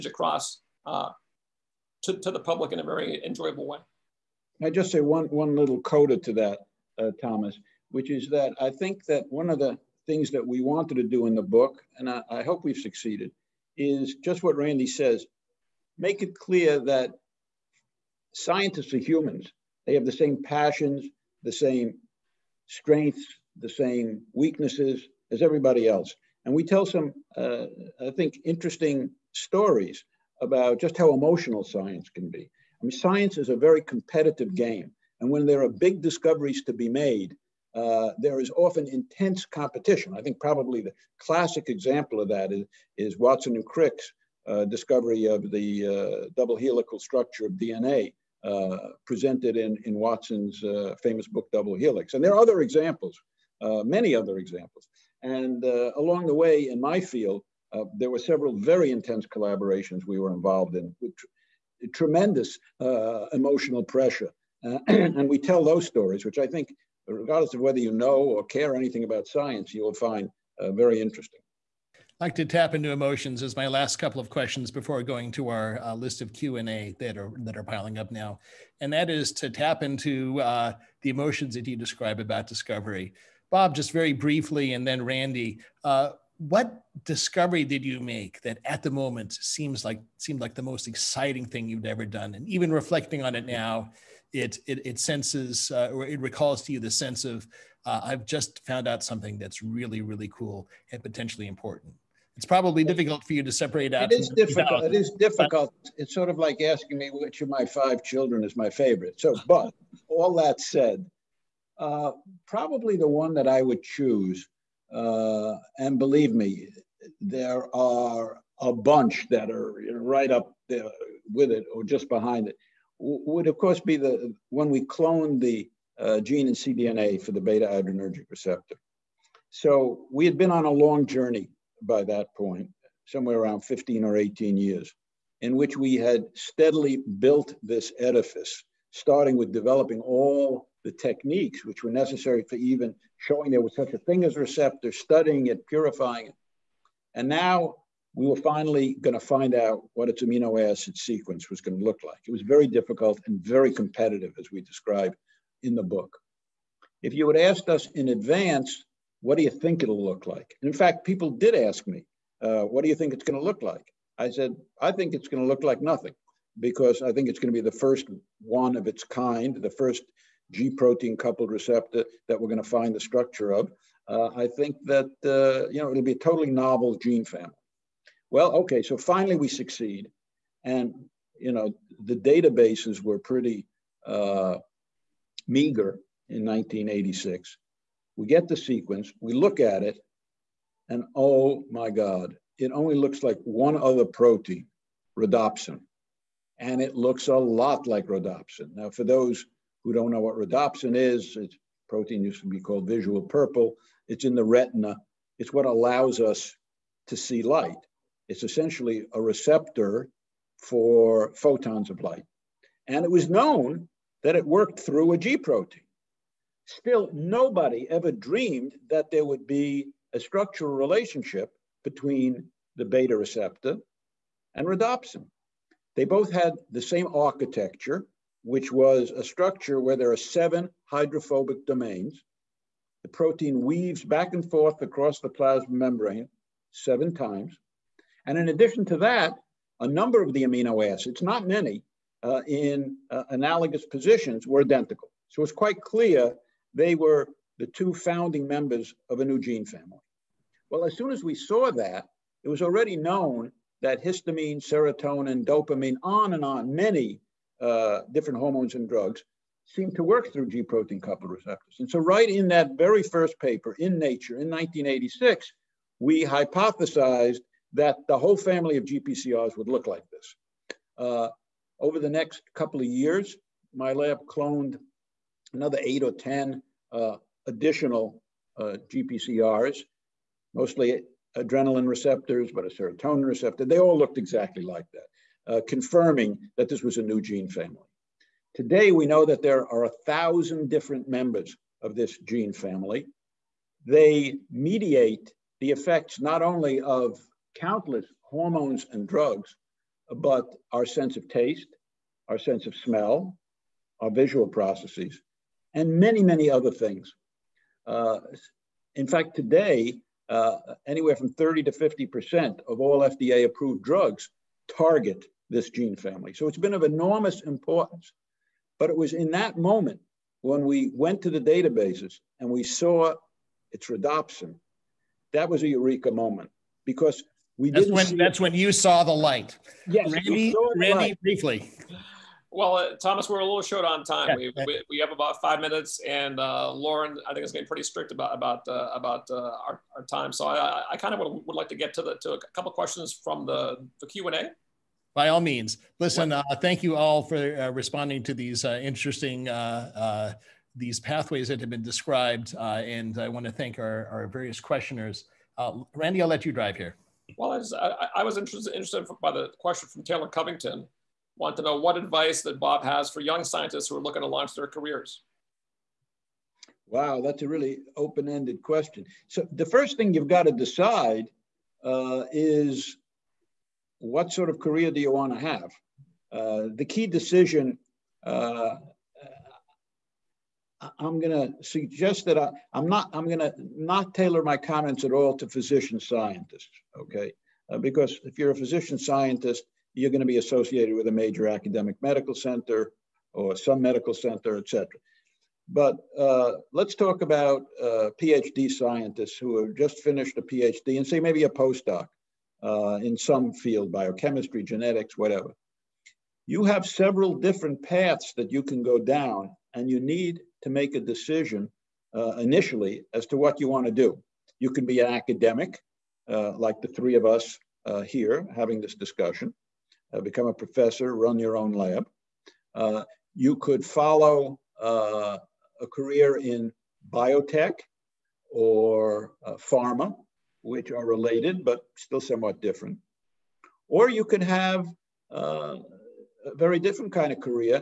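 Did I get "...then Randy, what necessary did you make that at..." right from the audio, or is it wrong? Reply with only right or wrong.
wrong.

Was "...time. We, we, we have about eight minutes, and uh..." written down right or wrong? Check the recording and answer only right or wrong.
wrong.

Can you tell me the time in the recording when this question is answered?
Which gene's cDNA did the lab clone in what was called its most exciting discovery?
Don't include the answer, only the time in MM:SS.
02:07.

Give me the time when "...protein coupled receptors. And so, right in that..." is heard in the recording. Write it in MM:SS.
04:20.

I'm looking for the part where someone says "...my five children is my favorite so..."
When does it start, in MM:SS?
01:47.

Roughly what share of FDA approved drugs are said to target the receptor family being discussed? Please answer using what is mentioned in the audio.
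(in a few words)
30 to 50%.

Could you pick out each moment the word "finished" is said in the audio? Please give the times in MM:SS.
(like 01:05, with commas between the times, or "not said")
06:39.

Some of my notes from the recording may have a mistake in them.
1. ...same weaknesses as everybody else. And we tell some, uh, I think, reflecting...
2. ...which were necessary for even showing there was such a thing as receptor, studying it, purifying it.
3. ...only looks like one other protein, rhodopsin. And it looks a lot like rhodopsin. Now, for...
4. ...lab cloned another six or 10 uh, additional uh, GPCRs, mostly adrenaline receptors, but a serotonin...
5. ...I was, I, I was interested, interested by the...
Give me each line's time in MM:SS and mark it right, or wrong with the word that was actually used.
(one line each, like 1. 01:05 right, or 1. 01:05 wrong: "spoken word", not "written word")
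1. 00:23 wrong: "interesting", not "reflecting"
2. 02:21 right
3. 03:12 right
4. 04:33 wrong: "eight", not "six"
5. 05:57 right.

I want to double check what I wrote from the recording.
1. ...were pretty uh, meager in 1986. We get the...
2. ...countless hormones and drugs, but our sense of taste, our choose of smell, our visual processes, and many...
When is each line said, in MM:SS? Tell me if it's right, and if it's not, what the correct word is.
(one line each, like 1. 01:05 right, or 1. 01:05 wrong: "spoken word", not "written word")
1. 03:03 right
2. 04:57 wrong: "sense", not "choose".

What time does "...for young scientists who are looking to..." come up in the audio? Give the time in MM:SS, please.
06:03.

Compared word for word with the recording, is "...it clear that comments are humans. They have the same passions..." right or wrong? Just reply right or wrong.
wrong.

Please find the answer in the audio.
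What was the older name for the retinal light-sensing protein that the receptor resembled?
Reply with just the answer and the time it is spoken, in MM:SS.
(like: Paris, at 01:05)
visual purple, at 03:22.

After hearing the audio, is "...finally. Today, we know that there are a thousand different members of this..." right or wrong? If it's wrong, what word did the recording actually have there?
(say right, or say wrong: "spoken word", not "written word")
wrong: "family", not "finally".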